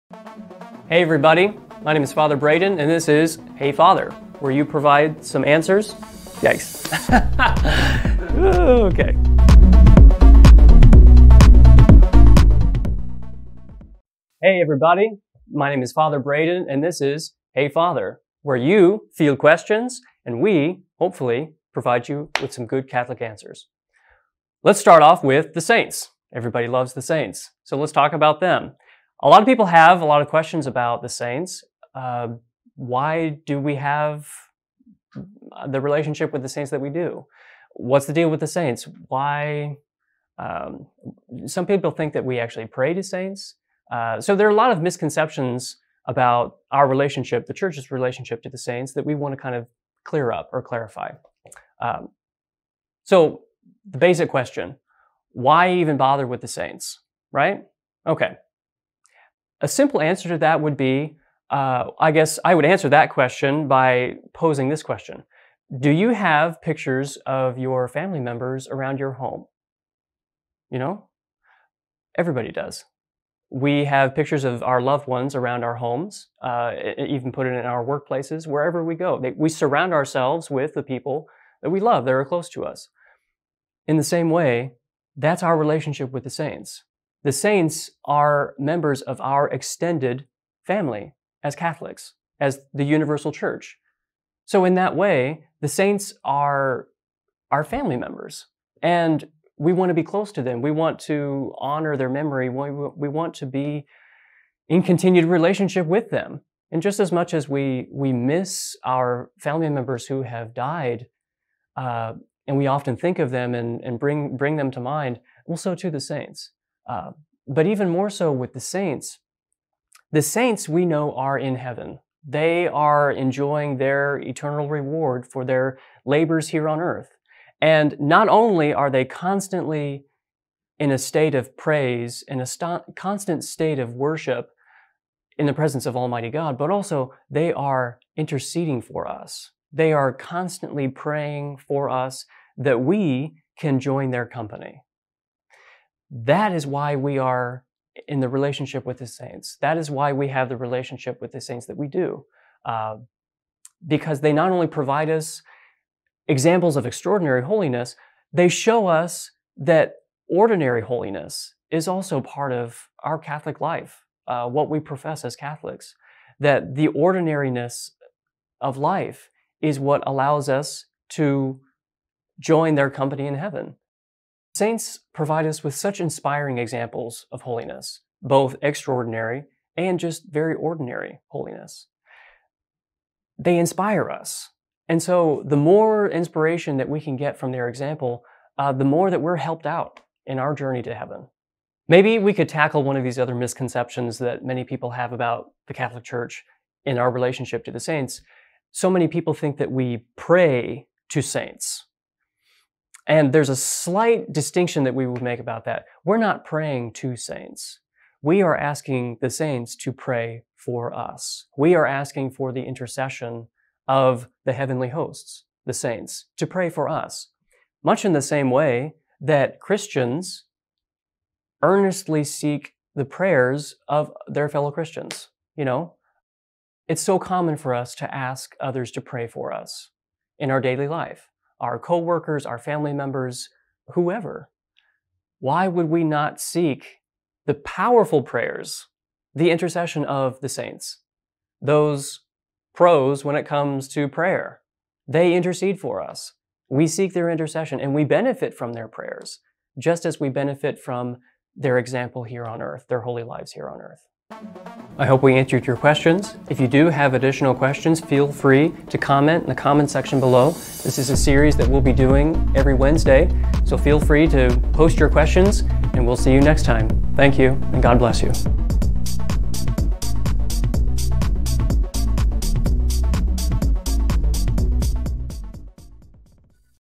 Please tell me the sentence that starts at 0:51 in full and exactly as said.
Um, so the basic question why even bother with the saints, right?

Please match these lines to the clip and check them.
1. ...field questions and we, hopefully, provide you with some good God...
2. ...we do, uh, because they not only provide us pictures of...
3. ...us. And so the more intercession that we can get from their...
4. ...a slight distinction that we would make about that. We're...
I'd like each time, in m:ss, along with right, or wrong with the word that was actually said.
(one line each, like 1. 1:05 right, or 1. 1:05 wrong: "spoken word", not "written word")
1. 0:19 wrong: "Catholic", not "God"
2. 2:31 wrong: "examples", not "pictures"
3. 3:04 wrong: "inspiration", not "intercession"
4. 3:23 right.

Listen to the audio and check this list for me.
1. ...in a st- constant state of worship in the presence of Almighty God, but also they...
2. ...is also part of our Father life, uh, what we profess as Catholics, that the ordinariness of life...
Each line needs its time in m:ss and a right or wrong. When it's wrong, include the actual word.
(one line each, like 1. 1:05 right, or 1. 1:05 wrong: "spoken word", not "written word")
1. 2:12 right
2. 2:41 wrong: "Catholic", not "Father".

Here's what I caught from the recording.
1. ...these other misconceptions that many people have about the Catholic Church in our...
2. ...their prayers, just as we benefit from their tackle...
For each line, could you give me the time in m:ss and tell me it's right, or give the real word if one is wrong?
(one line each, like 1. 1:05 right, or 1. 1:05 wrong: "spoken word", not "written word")
1. 3:13 right
2. 4:08 wrong: "example", not "tackle".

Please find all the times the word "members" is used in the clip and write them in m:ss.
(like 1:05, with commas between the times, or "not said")
1:08, 1:28, 1:37, 1:49, 3:52.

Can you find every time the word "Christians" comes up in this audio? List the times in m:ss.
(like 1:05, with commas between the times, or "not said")
3:39, 3:44.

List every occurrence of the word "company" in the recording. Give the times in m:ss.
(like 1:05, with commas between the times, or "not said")
2:24, 2:52.